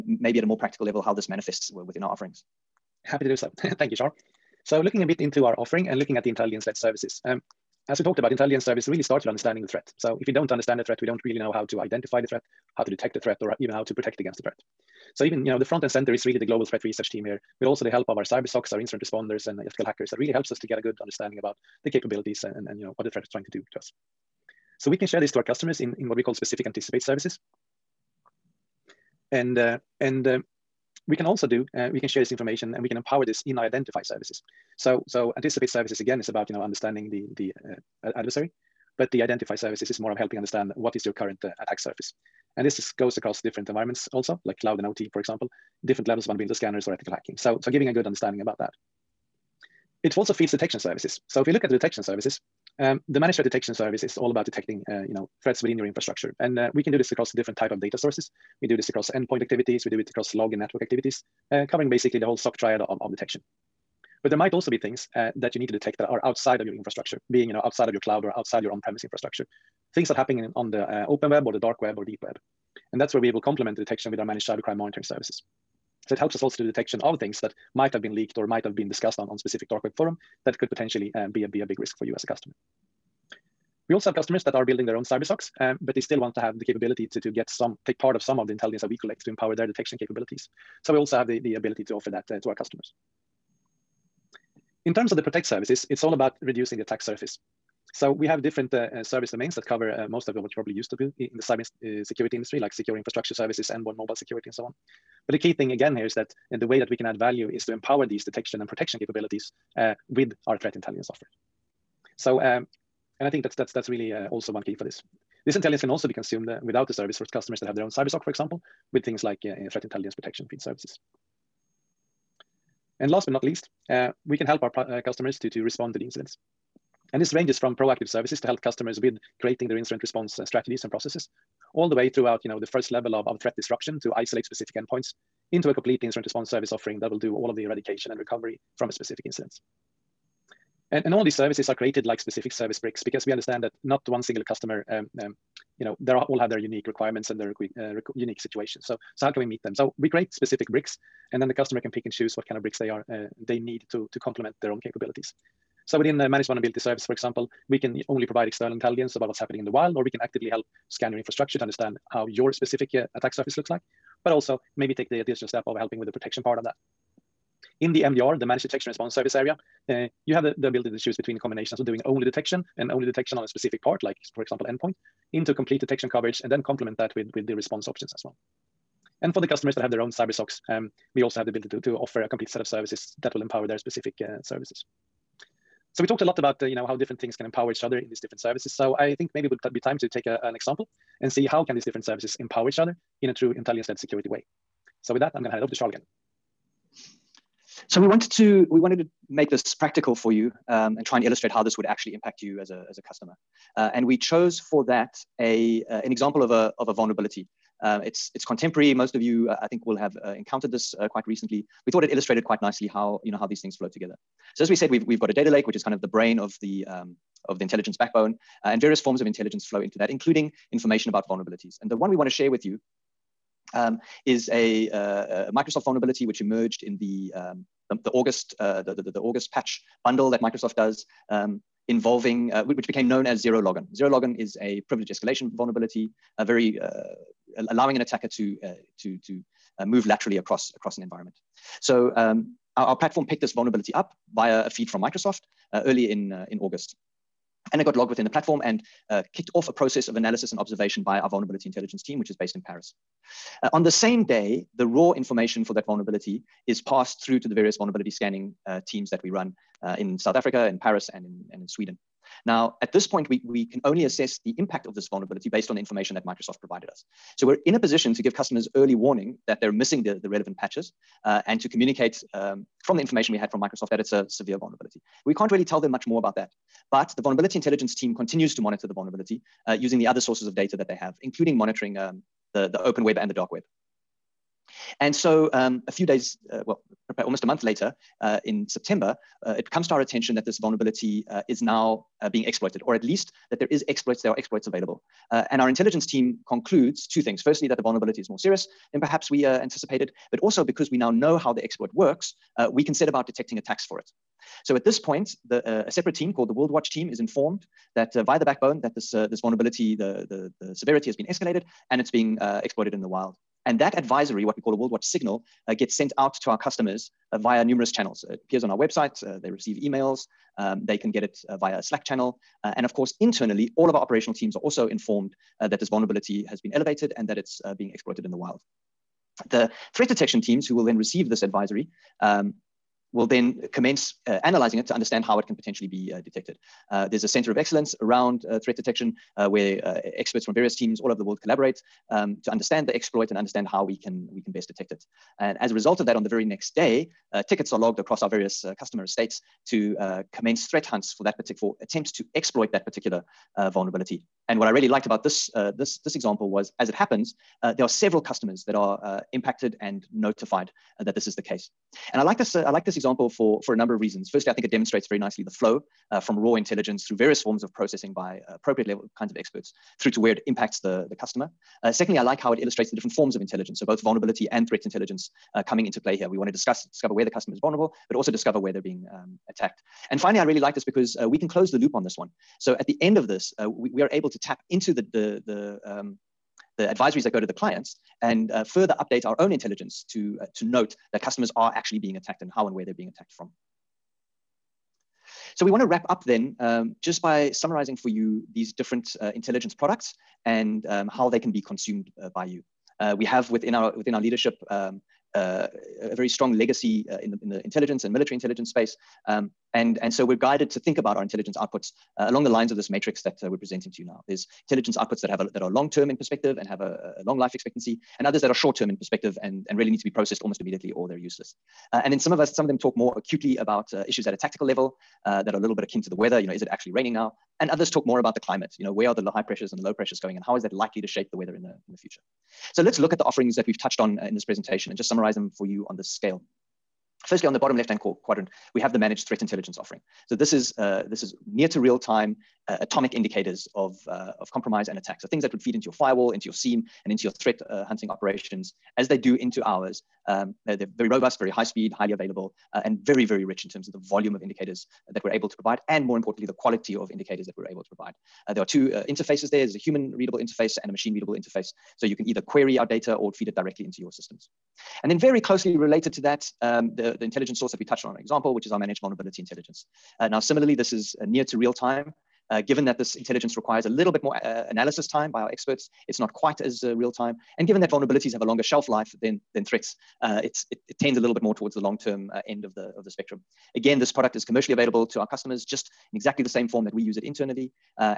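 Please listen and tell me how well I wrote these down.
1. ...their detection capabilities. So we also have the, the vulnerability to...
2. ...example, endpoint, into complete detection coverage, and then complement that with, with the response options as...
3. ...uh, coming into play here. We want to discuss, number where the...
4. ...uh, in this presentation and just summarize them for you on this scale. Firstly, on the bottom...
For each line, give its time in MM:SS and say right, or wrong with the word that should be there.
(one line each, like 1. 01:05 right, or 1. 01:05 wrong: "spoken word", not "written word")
1. 01:29 wrong: "ability", not "vulnerability"
2. 02:54 right
3. 06:15 wrong: "discover", not "number"
4. 07:14 right.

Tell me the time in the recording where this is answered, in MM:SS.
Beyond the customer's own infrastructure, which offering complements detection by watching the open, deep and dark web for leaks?
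01:14.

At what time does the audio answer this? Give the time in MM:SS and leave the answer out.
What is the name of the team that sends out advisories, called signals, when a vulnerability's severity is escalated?
05:06.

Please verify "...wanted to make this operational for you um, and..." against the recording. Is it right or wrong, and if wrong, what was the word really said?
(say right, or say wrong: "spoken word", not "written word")
wrong: "practical", not "operational".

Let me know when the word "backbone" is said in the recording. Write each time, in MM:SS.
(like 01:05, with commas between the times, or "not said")
03:37, 05:08.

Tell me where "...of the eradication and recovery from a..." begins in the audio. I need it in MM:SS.
02:17.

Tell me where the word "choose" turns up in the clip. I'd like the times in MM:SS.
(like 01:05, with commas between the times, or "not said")
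02:32, 02:50.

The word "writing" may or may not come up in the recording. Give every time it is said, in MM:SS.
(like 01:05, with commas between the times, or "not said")
not said.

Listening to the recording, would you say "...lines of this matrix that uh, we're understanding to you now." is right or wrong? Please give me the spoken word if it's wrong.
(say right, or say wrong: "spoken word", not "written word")
wrong: "presenting", not "understanding".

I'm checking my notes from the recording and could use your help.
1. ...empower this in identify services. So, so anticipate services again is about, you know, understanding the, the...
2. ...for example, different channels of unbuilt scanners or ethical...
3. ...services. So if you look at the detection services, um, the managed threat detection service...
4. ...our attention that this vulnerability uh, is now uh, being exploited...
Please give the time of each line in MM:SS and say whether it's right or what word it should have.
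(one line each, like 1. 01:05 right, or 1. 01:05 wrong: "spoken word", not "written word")
1. 00:32 right
2. 00:45 wrong: "levels", not "channels"
3. 00:50 right
4. 04:49 right.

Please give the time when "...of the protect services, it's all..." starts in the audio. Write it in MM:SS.
01:35.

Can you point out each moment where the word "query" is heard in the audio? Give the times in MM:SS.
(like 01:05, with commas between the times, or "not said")
07:42.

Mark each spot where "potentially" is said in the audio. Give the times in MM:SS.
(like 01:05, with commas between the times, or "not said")
01:20, 05:35.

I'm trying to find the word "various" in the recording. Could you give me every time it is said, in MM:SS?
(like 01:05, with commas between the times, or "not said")
03:38, 04:17, 05:40, 05:48, 06:07.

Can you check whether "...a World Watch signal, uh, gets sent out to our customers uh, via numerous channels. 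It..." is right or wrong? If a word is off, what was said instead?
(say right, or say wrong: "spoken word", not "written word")
right.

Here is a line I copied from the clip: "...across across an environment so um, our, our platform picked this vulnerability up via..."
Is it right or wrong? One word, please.
right.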